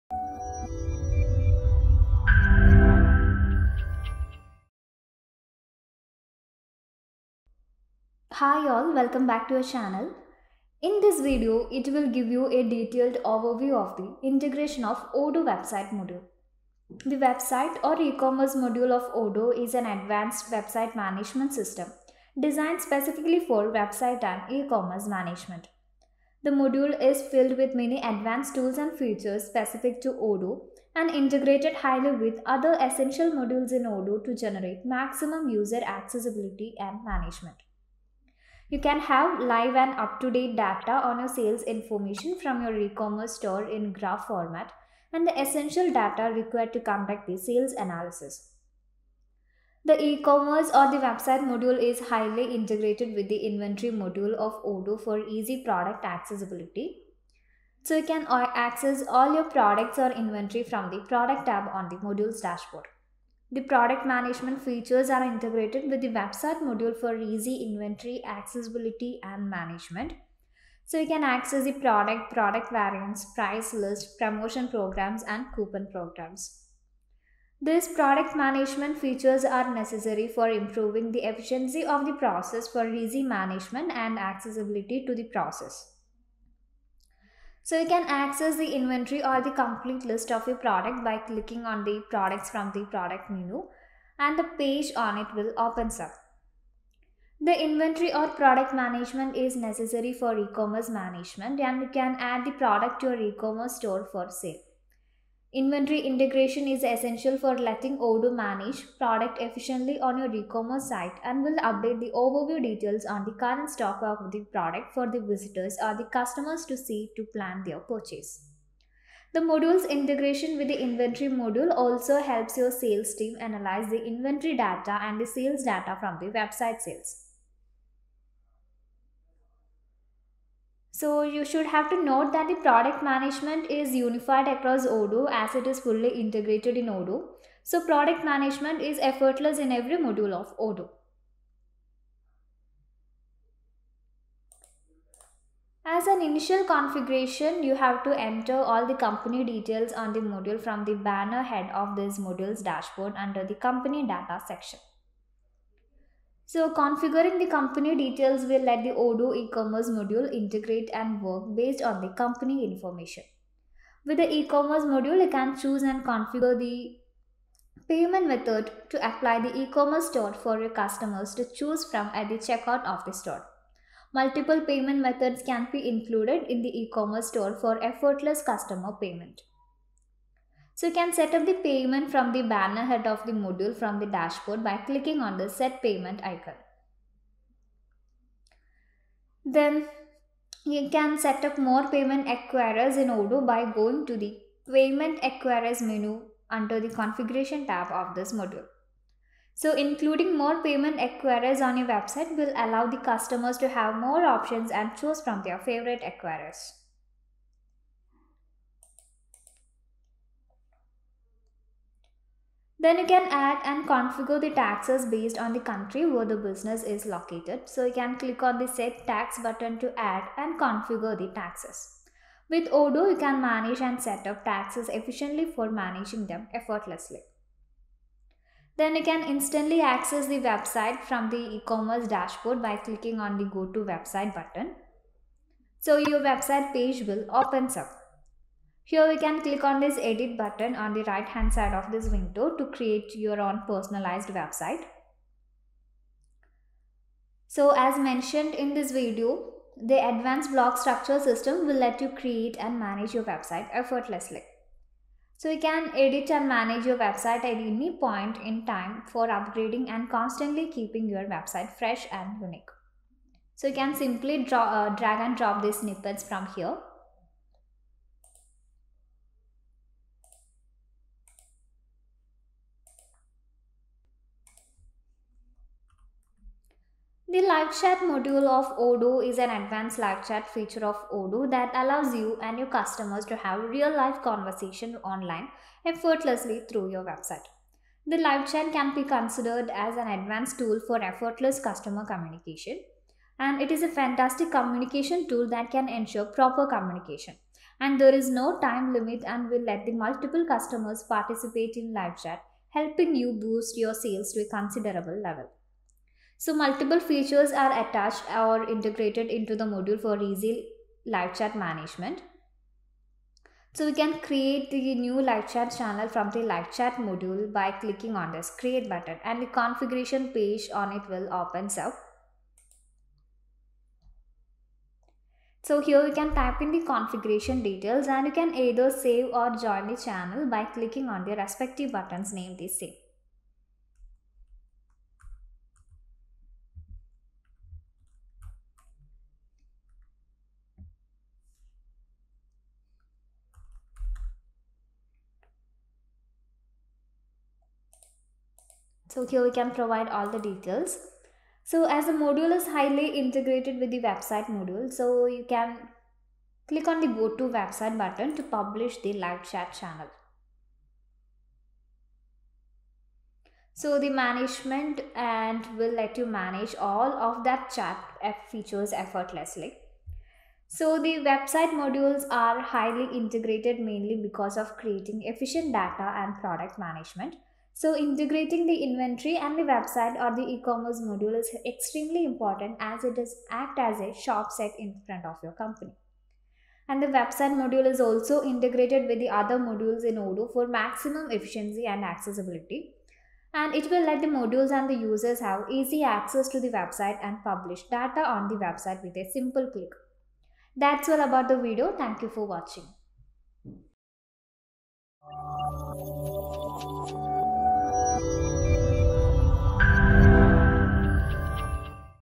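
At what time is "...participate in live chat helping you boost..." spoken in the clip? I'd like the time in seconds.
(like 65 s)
301 s.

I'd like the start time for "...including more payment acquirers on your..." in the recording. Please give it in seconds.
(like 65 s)
199 s.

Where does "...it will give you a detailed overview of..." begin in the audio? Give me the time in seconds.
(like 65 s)
11 s.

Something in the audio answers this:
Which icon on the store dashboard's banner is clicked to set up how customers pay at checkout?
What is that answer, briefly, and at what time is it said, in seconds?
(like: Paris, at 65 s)
set payment, at 185 s.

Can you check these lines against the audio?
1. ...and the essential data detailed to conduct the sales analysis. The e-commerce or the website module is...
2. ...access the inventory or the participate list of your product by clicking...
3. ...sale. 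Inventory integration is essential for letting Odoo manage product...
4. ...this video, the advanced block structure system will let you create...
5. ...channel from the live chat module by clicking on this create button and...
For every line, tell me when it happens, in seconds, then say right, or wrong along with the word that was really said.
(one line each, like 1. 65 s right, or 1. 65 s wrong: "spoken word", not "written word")
1. 45 s wrong: "required", not "detailed"
2. 88 s wrong: "complete", not "participate"
3. 104 s right
4. 248 s right
5. 315 s right.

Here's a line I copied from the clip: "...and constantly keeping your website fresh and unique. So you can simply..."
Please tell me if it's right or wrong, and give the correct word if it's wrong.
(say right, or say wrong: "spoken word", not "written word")
right.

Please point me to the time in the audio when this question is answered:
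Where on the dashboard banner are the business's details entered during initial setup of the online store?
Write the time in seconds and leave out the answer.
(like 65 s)
153 s.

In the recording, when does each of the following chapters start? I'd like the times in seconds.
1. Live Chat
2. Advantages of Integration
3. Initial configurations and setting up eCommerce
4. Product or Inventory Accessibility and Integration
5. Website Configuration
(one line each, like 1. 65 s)
1. 277 s
2. 370 s
3. 145 s
4. 93 s
5. 228 s.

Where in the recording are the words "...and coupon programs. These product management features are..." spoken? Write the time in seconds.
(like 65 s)
75 s.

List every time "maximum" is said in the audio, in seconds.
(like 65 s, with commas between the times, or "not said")
34 s, 390 s.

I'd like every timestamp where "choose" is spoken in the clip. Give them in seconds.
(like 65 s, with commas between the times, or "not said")
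165 s, 171 s, 204 s.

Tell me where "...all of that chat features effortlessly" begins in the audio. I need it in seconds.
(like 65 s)
366 s.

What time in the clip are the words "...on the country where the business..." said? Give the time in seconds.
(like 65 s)
215 s.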